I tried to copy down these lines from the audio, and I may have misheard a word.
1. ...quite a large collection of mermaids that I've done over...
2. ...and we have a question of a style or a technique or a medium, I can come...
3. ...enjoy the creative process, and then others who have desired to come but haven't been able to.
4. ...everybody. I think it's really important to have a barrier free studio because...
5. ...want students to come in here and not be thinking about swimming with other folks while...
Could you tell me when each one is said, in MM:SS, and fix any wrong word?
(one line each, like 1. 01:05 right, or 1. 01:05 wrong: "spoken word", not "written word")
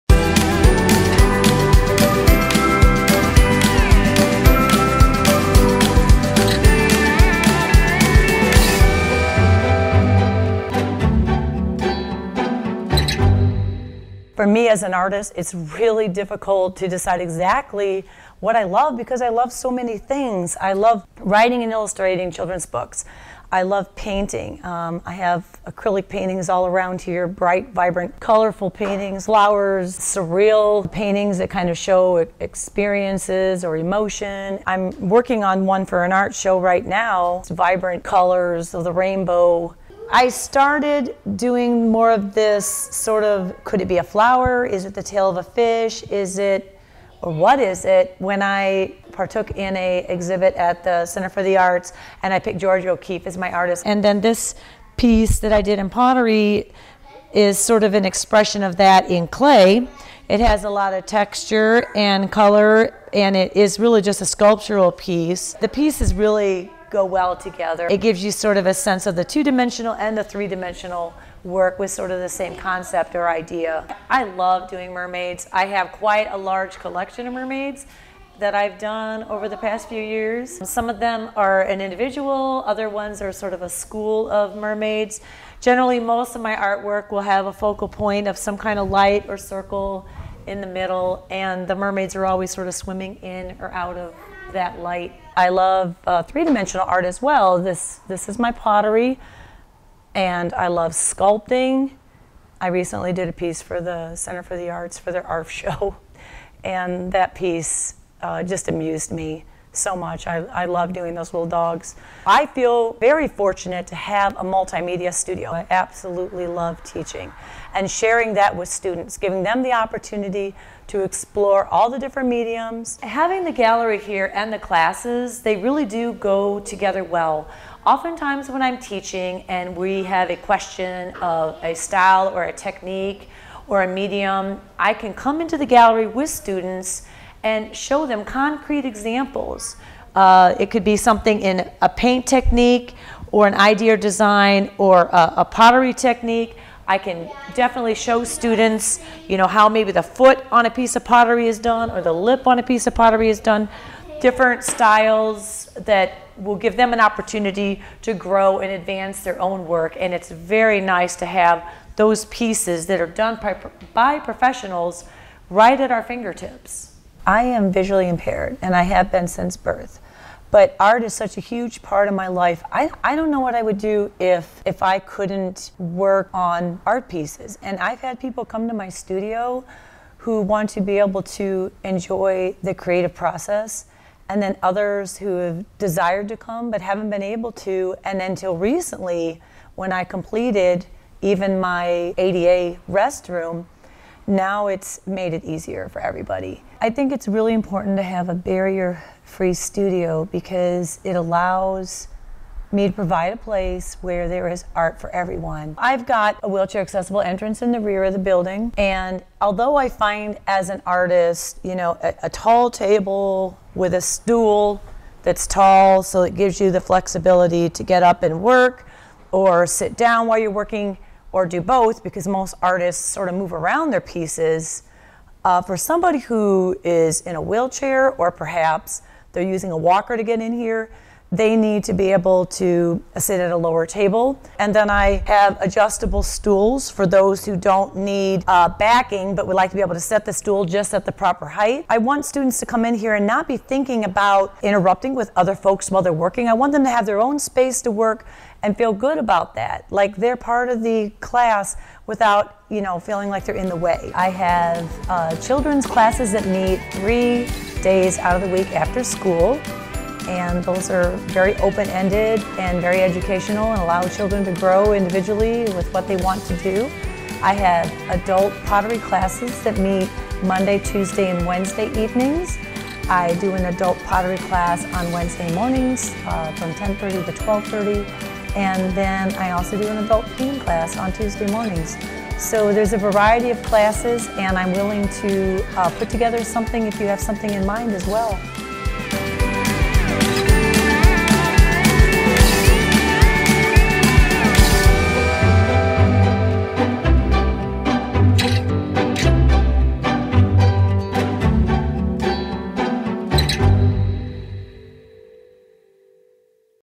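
1. 01:15 right
2. 02:09 right
3. 03:01 right
4. 03:16 right
5. 04:01 wrong: "interrupting", not "swimming".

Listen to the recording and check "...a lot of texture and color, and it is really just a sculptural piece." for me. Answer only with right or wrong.
right.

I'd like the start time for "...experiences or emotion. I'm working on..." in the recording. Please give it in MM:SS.
00:32.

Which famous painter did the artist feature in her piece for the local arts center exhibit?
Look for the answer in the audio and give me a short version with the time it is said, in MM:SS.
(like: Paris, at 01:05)
Georgia O'Keeffe, at 00:52.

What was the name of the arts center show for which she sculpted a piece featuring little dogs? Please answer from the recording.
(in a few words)
ARF.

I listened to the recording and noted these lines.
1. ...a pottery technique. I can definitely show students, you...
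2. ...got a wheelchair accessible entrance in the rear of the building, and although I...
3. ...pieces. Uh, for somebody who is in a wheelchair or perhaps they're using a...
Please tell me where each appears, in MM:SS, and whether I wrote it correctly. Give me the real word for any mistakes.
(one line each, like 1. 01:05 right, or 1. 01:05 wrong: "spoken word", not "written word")
1. 02:25 right
2. 03:26 right
3. 03:44 right.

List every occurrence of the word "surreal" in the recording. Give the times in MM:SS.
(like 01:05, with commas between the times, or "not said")
00:29.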